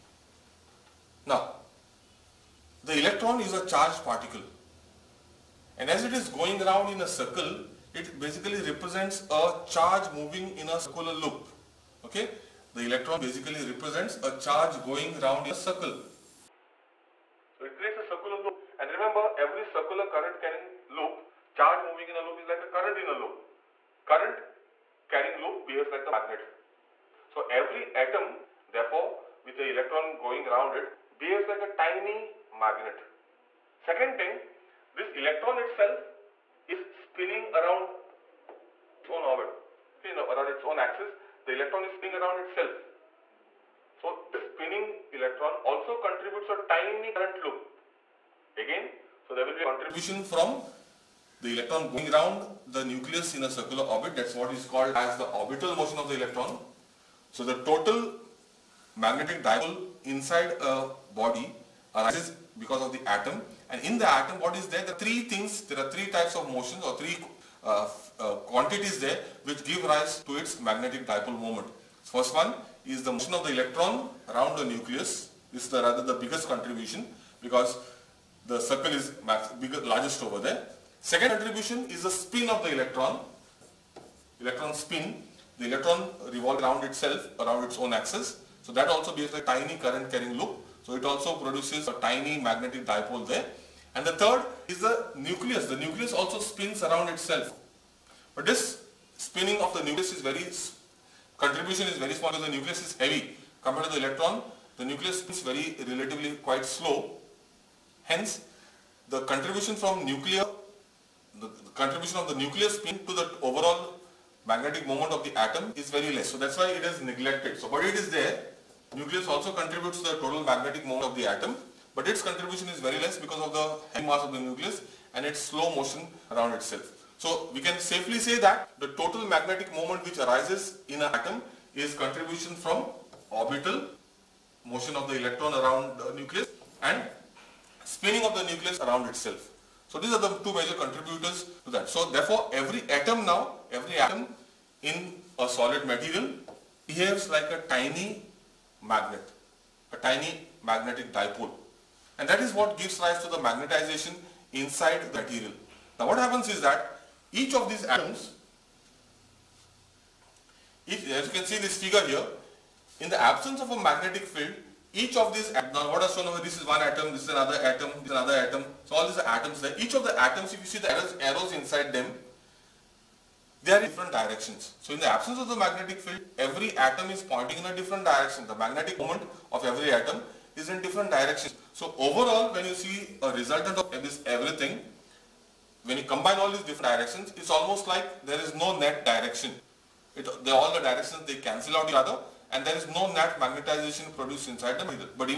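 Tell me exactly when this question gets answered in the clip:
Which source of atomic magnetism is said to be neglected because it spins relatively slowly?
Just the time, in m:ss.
1:52.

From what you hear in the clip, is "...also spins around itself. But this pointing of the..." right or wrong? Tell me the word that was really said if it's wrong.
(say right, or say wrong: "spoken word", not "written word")
wrong: "spinning", not "pointing".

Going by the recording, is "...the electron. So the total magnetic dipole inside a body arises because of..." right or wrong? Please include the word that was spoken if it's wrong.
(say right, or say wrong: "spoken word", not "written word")
right.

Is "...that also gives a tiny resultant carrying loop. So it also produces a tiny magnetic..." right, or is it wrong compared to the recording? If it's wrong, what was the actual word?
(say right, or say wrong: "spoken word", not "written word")
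wrong: "current", not "resultant".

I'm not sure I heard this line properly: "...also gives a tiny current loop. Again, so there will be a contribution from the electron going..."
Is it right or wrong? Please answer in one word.
wrong.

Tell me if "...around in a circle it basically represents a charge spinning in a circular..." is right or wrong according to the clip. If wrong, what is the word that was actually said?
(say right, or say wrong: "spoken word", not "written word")
wrong: "moving", not "spinning".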